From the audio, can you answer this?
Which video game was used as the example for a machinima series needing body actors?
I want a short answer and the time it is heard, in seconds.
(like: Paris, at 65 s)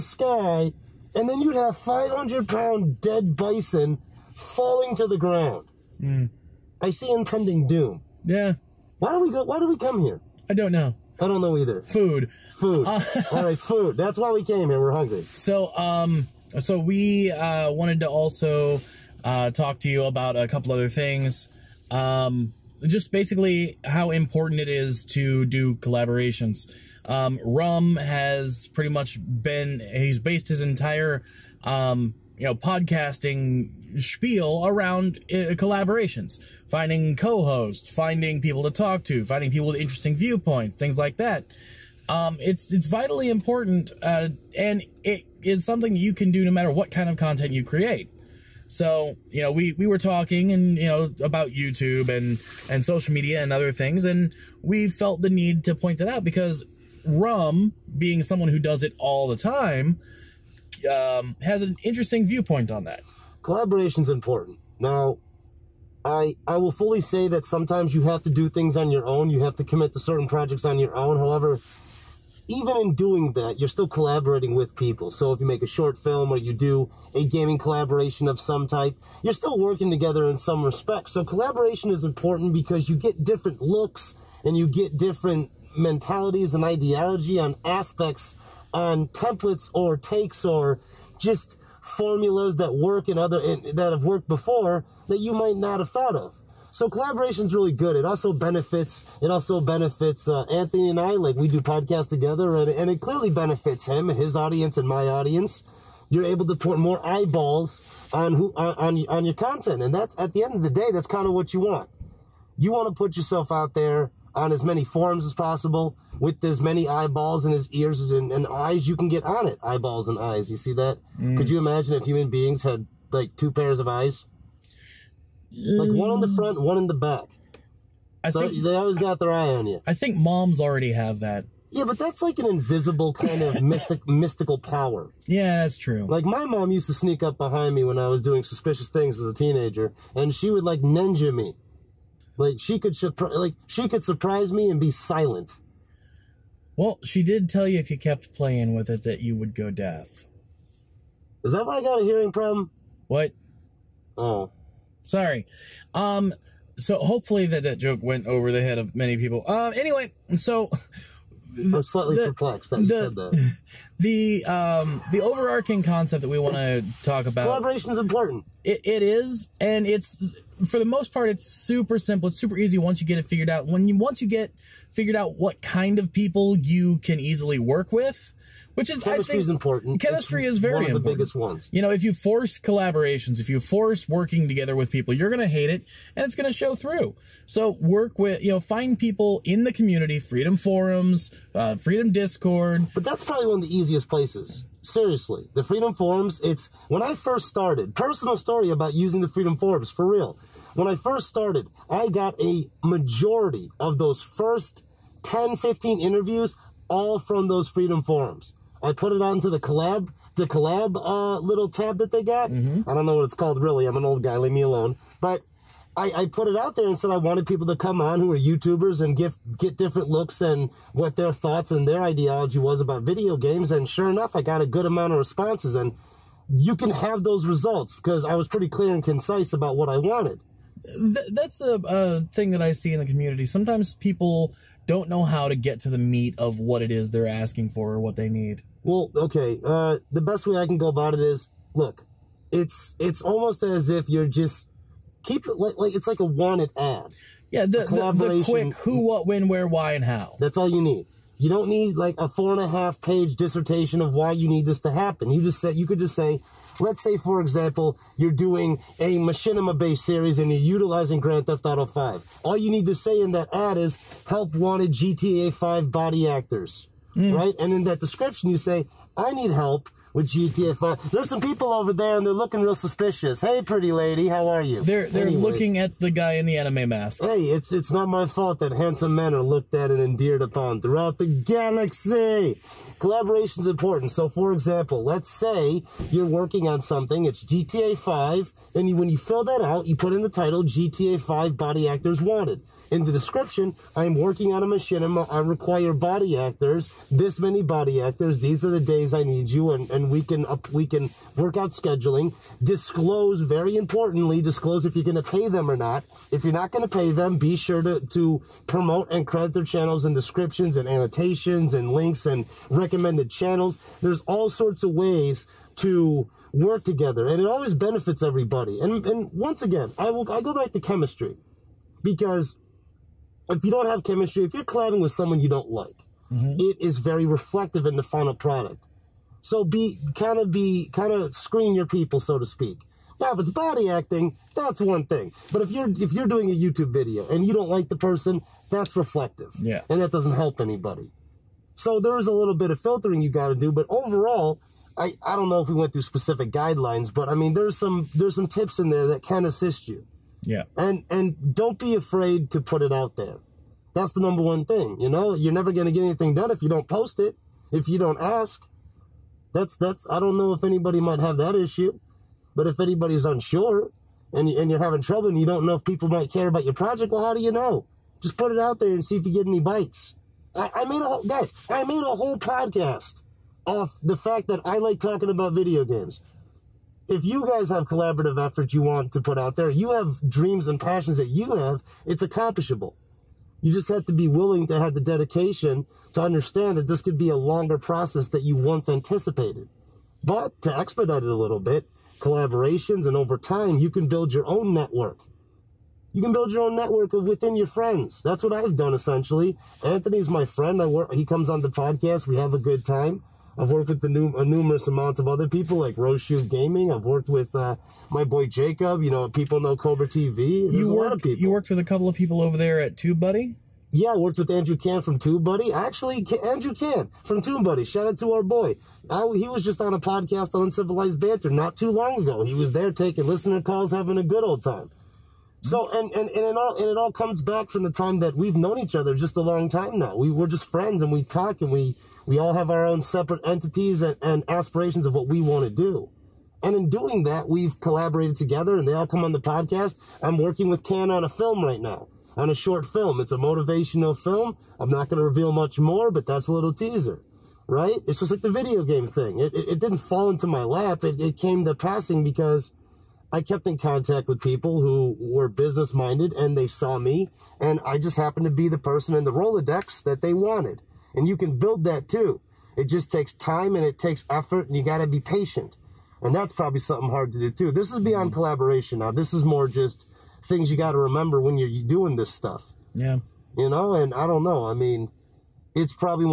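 Grand Theft Auto 5, at 261 s.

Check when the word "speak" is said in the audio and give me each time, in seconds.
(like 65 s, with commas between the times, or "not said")
332 s.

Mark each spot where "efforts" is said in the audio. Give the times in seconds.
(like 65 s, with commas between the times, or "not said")
378 s, 464 s.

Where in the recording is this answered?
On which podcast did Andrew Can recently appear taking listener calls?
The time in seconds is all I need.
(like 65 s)
420 s.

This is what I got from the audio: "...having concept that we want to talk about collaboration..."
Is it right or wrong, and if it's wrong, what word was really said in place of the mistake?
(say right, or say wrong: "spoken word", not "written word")
wrong: "overarching", not "having".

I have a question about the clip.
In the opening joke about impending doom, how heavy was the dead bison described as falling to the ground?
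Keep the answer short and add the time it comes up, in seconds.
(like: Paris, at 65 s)
500 pounds, at 1 s.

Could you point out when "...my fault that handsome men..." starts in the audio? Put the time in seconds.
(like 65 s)
278 s.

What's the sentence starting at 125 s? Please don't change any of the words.
Like one on the front, one in the back.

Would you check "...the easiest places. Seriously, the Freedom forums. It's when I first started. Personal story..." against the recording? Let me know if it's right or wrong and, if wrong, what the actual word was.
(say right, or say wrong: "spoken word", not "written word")
right.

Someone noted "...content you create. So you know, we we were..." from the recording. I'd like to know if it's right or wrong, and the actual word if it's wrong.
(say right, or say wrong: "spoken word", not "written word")
right.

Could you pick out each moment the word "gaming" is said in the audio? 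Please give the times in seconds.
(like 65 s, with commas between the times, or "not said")
77 s, 406 s.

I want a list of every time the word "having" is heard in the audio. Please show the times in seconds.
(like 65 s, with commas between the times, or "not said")
364 s, 423 s.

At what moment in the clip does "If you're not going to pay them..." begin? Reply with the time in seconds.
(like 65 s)
306 s.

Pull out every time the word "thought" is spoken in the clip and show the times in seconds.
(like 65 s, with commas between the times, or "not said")
95 s, 221 s.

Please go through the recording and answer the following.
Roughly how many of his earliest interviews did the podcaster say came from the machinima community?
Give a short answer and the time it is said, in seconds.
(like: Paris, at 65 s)
10 to 15, at 205 s.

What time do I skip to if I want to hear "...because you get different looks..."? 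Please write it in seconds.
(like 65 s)
82 s.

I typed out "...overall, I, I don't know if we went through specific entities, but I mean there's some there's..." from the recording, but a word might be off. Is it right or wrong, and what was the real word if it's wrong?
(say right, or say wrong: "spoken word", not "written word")
wrong: "guidelines", not "entities".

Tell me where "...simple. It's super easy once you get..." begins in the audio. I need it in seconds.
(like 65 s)
171 s.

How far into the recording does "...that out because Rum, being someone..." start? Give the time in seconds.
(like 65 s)
55 s.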